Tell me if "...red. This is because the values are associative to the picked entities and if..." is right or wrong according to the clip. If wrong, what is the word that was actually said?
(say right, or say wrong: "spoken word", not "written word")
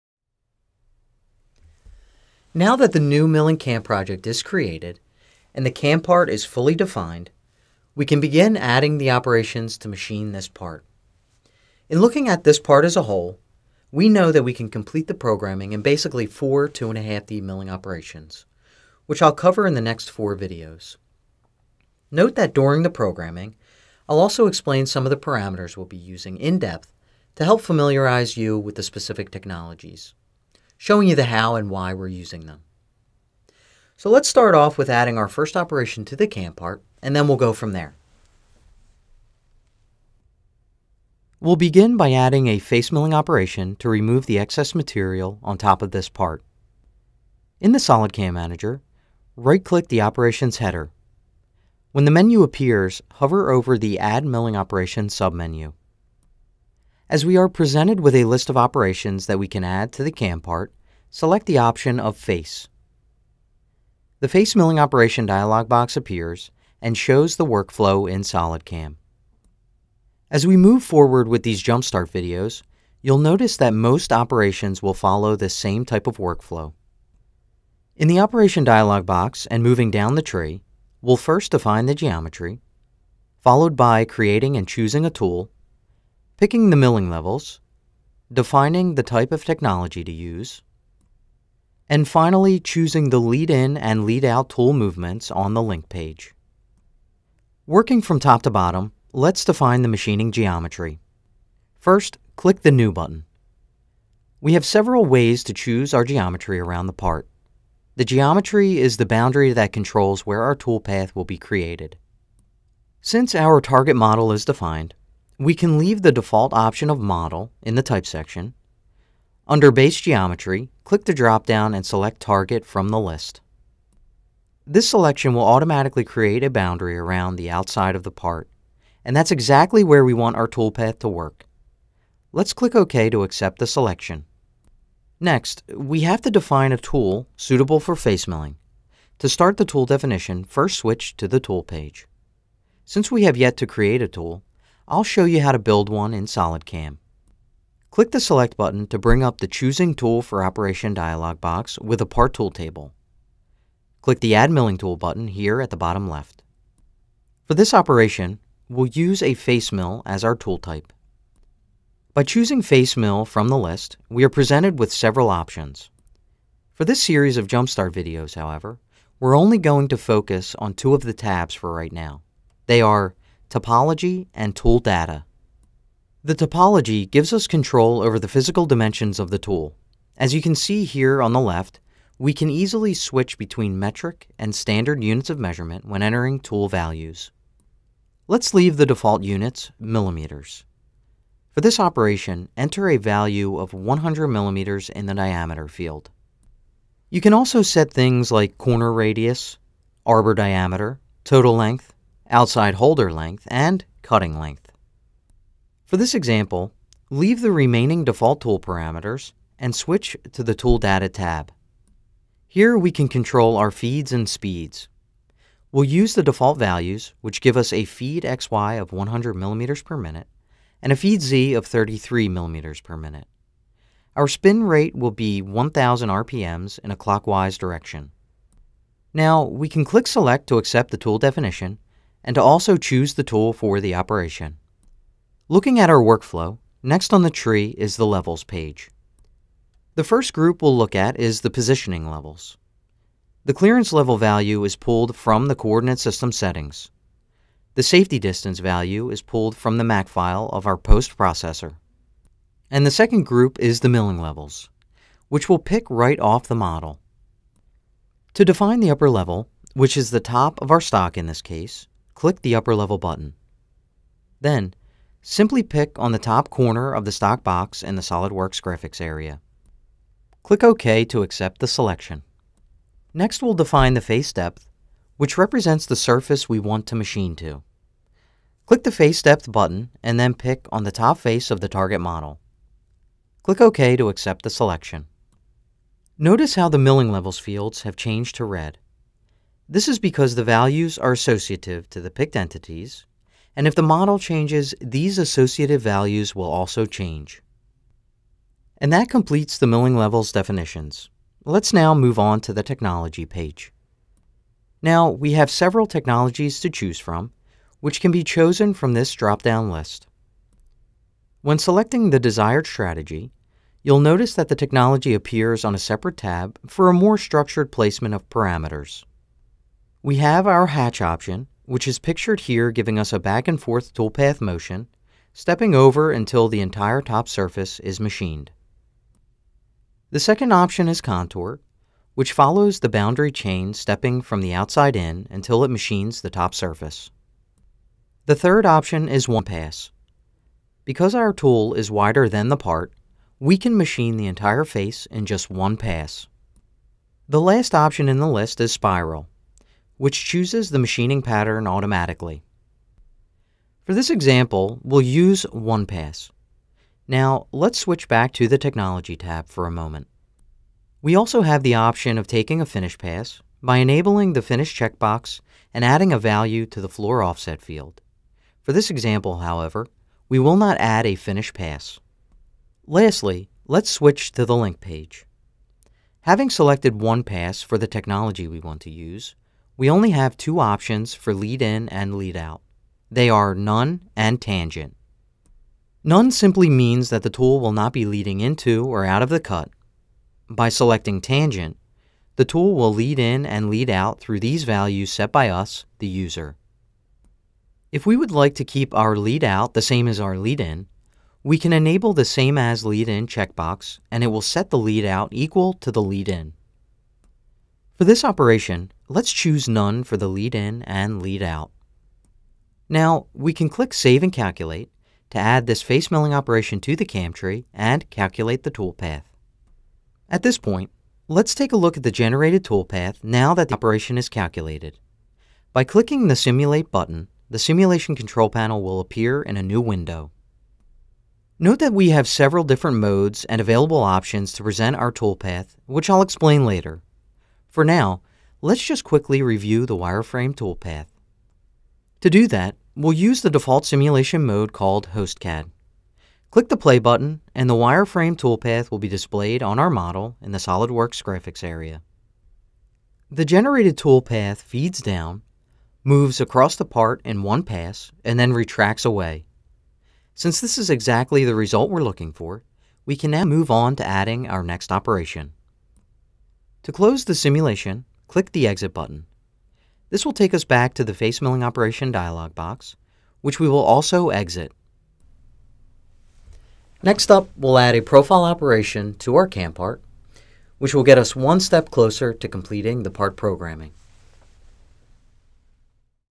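right.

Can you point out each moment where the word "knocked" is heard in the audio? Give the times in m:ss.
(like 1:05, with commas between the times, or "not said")
not said.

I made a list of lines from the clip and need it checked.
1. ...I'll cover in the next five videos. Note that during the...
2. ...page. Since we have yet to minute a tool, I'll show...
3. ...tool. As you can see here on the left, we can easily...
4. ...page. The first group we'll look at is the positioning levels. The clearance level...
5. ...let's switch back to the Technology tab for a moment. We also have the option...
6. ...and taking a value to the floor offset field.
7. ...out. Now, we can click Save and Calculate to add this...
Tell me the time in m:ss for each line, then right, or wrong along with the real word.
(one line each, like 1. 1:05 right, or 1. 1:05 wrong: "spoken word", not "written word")
1. 0:19 wrong: "four", not "five"
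2. 2:21 wrong: "create", not "minute"
3. 2:59 right
4. 3:58 right
5. 5:57 right
6. 6:05 wrong: "adding", not "taking"
7. 6:51 right.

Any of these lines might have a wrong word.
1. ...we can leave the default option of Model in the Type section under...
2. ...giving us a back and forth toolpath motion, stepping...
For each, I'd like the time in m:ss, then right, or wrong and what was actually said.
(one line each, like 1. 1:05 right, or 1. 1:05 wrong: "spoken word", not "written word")
1. 1:55 right
2. 5:22 right.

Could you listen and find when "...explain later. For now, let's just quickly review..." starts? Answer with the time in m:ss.
7:16.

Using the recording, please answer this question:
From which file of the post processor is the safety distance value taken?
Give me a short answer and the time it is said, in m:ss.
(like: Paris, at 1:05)
MAC file, at 4:09.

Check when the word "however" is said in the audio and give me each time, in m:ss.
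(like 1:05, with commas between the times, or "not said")
2:48, 6:09.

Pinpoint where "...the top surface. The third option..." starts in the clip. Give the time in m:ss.
5:36.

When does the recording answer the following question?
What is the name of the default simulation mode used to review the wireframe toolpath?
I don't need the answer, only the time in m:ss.
7:25.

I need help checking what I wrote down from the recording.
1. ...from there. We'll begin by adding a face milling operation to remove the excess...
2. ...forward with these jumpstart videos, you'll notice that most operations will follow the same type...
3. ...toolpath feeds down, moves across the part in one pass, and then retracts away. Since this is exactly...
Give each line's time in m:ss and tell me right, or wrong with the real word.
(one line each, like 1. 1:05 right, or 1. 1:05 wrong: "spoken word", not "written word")
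1. 0:37 right
2. 1:10 right
3. 7:33 right.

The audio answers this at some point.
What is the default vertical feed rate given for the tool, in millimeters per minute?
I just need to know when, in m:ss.
3:41.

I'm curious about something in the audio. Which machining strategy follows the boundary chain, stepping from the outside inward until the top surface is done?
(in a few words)
Contour.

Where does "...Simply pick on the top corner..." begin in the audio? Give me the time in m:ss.
4:25.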